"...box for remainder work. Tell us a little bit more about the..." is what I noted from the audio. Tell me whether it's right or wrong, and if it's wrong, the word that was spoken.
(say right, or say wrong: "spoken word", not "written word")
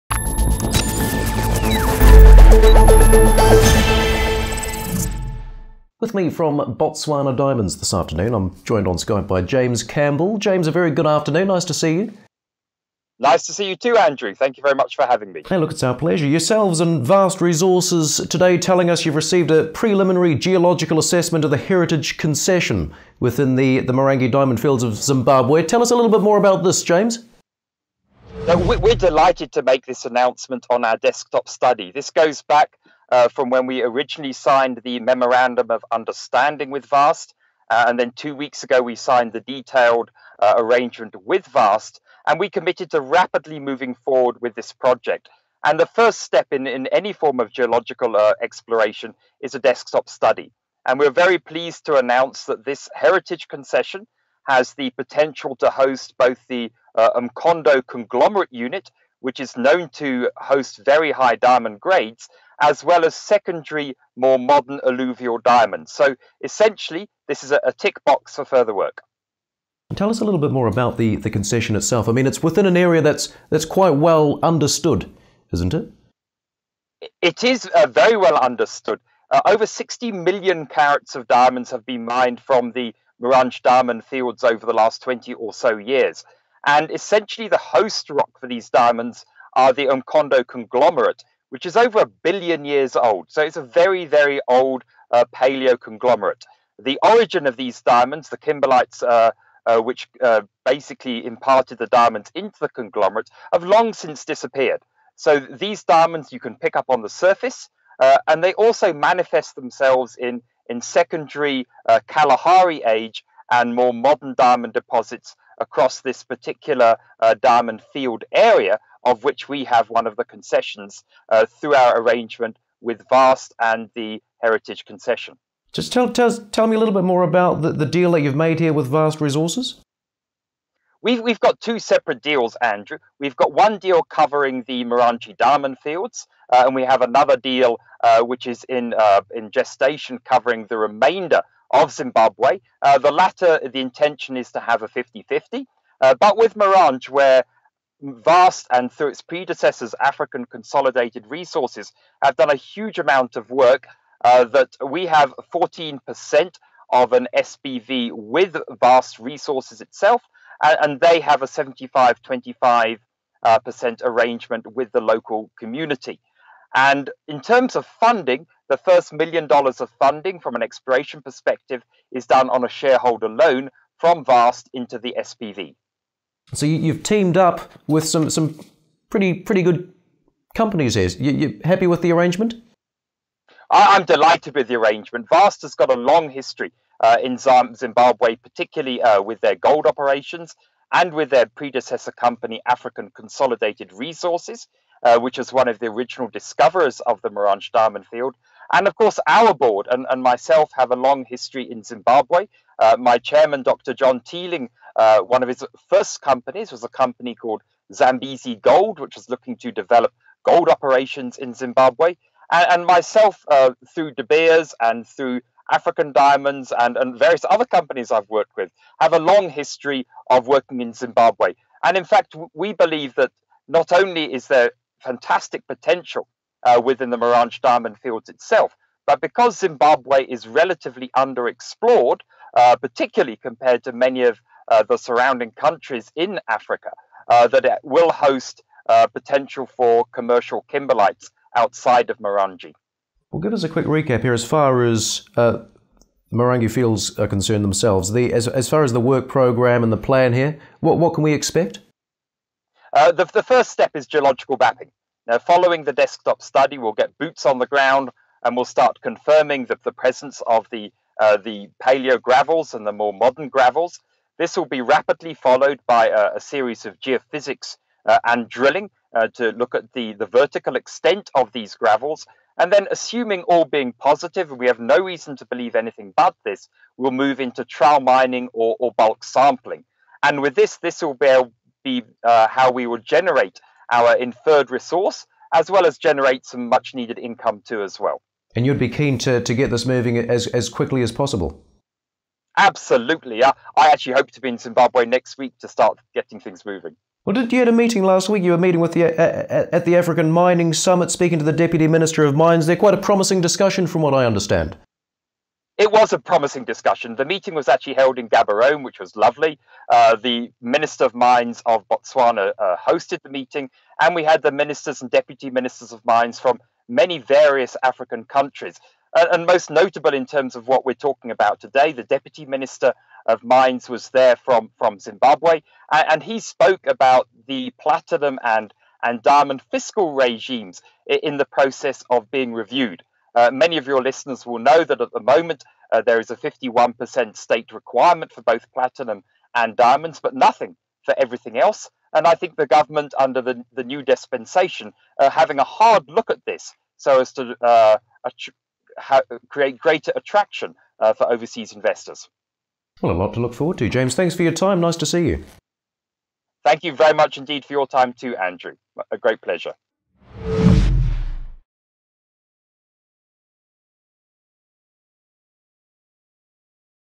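wrong: "further", not "remainder".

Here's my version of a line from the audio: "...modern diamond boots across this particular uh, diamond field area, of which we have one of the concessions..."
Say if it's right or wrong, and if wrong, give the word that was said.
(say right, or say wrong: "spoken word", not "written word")
wrong: "deposits", not "boots".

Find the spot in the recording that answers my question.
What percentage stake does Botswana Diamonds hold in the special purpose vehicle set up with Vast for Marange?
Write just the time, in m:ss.
2:35.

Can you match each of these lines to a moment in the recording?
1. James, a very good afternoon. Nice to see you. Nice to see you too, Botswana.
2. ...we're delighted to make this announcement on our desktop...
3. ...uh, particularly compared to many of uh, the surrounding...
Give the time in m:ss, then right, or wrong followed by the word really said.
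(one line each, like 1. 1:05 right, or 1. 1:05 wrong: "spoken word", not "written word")
1. 0:10 wrong: "Andrew", not "Botswana"
2. 0:28 right
3. 3:52 right.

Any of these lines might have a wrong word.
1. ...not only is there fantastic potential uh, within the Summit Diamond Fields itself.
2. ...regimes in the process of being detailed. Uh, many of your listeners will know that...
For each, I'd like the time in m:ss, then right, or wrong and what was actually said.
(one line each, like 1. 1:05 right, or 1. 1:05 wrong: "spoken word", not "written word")
1. 3:43 wrong: "Marange", not "Summit"
2. 5:30 wrong: "reviewed", not "detailed".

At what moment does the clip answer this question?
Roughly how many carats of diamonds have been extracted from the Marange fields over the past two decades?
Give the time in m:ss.
1:19.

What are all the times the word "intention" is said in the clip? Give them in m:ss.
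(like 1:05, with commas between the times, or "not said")
2:23.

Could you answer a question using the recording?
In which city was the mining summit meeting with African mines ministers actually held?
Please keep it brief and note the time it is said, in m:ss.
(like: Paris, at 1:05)
Gaborone, at 5:08.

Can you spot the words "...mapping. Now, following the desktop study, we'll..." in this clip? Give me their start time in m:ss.
4:14.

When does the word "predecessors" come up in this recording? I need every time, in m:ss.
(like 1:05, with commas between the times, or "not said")
2:29, 3:11.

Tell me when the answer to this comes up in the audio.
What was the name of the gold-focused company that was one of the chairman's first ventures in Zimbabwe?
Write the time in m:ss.
3:27.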